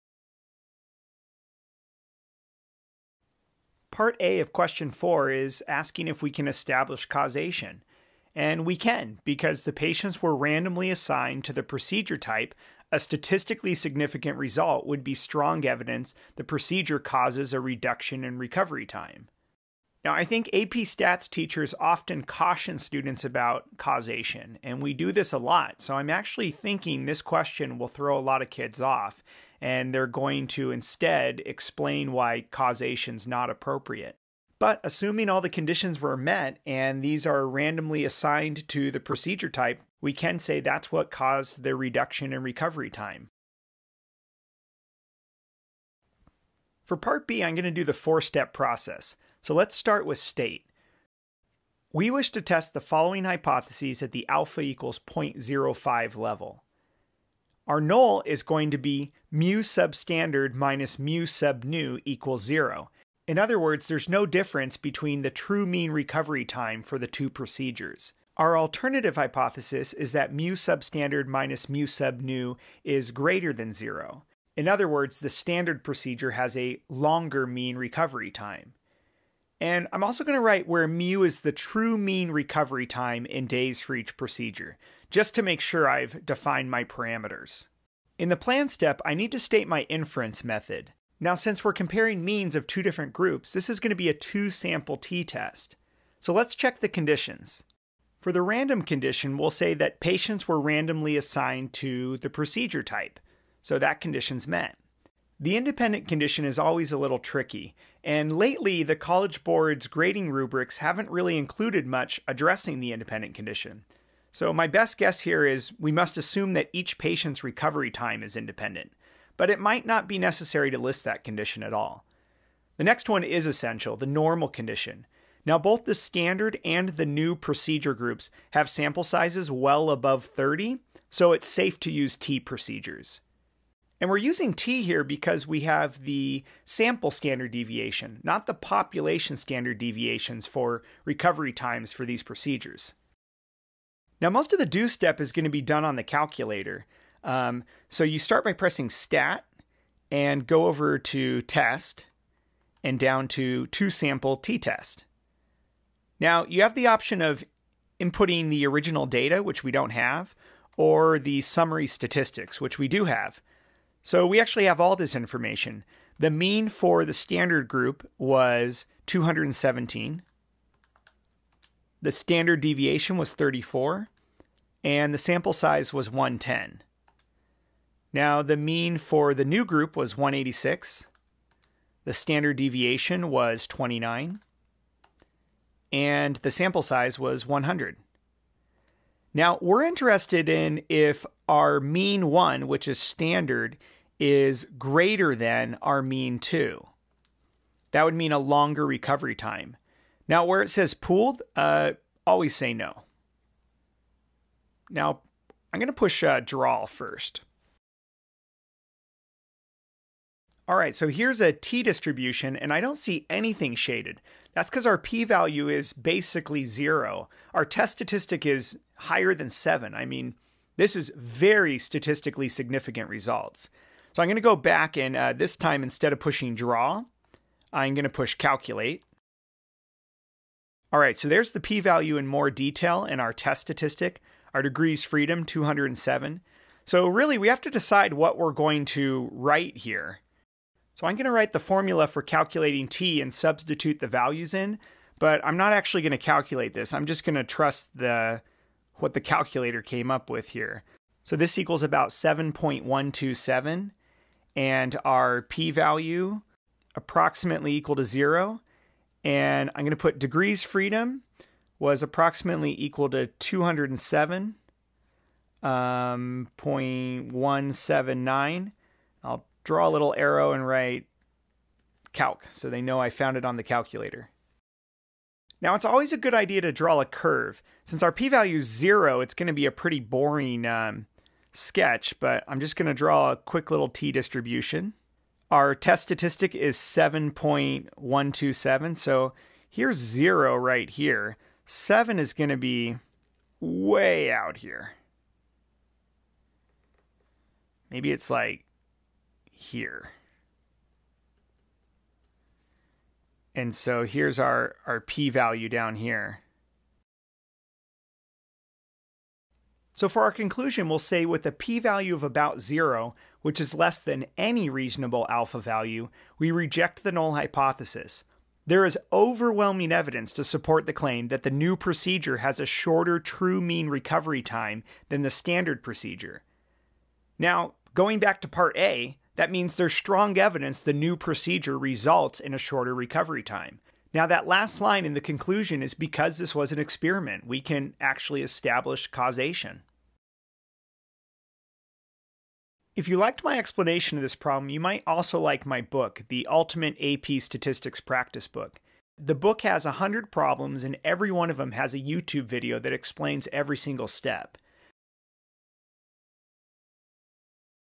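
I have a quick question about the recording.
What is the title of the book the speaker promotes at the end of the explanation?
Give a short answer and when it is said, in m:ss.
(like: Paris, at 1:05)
The Ultimate AP Statistics Practice Book, at 5:46.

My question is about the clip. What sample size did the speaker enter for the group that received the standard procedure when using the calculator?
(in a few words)
110.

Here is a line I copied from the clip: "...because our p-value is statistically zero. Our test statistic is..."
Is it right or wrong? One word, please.
wrong.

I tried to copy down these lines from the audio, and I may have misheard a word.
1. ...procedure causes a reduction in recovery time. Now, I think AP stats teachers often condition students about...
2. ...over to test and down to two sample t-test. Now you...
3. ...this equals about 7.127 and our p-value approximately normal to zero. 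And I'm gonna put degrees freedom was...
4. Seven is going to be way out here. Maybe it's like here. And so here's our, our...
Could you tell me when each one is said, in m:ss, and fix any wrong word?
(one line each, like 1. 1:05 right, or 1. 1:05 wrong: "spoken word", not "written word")
1. 0:16 wrong: "caution", not "condition"
2. 2:30 right
3. 4:11 wrong: "equal", not "normal"
4. 4:51 right.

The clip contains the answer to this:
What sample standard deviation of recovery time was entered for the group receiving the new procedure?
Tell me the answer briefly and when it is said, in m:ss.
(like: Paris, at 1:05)
29, at 3:03.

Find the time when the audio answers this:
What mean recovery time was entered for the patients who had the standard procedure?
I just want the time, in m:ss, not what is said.
2:49.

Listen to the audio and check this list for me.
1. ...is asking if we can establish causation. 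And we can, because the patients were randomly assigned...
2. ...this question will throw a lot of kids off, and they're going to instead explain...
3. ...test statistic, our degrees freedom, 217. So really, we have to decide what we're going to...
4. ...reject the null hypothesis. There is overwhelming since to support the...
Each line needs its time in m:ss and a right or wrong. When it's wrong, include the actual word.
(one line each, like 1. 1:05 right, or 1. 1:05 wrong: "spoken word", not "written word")
1. 0:05 right
2. 0:27 right
3. 3:53 wrong: "207", not "217"
4. 5:16 wrong: "evidence", not "since".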